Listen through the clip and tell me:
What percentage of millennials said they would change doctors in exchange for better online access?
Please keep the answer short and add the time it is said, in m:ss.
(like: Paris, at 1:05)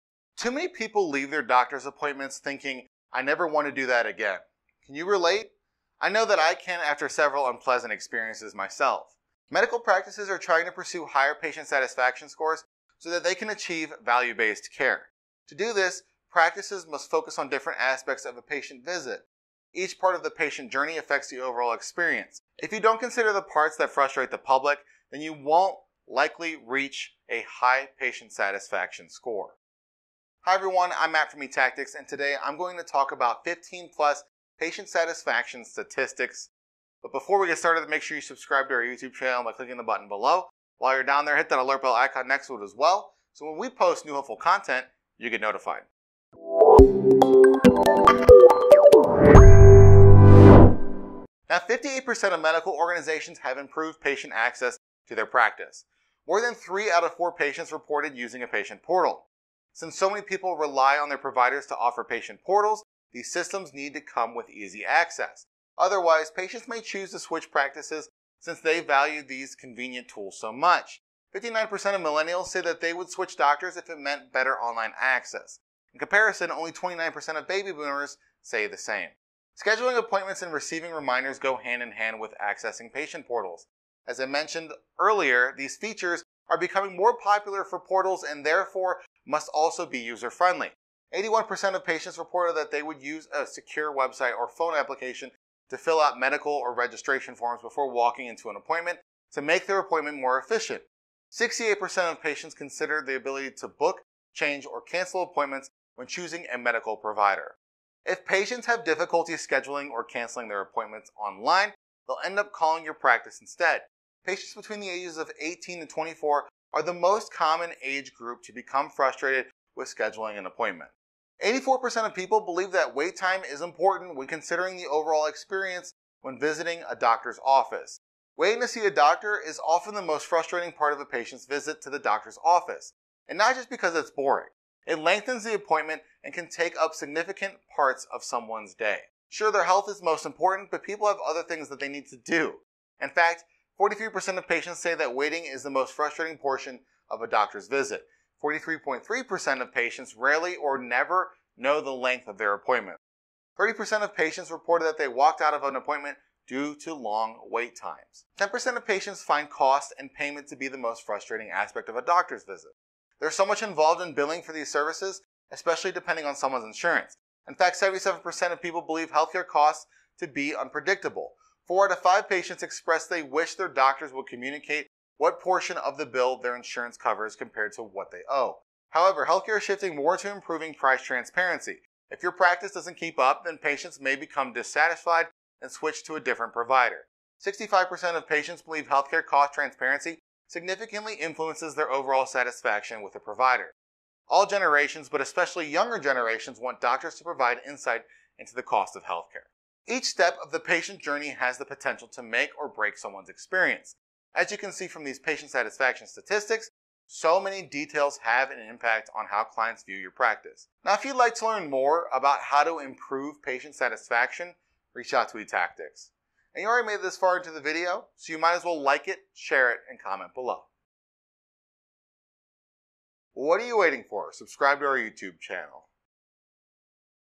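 59%, at 1:11.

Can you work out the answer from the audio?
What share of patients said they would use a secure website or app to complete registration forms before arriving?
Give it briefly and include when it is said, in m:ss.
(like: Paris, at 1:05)
81%, at 1:31.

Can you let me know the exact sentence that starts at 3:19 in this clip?
Each step of the patient journey has the potential to make or break someone's experience.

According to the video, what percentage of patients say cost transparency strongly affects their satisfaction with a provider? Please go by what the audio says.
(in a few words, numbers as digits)
65%.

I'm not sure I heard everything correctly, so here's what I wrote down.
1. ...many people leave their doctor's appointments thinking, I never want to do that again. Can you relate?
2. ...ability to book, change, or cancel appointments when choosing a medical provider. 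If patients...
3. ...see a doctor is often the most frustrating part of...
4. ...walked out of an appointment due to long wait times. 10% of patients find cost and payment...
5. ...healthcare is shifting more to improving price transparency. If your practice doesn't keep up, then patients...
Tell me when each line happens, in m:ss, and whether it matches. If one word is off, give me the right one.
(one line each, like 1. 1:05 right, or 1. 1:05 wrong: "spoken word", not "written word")
1. 0:00 right
2. 1:43 right
3. 2:08 right
4. 2:35 right
5. 2:59 right.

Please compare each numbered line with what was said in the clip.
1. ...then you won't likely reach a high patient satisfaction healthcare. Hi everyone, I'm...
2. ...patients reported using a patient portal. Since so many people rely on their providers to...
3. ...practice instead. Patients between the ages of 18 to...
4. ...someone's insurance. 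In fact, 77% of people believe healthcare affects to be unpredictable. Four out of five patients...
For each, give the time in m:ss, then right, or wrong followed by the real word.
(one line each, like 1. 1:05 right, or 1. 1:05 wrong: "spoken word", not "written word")
1. 0:25 wrong: "score", not "healthcare"
2. 0:57 right
3. 1:52 right
4. 2:46 wrong: "costs", not "affects".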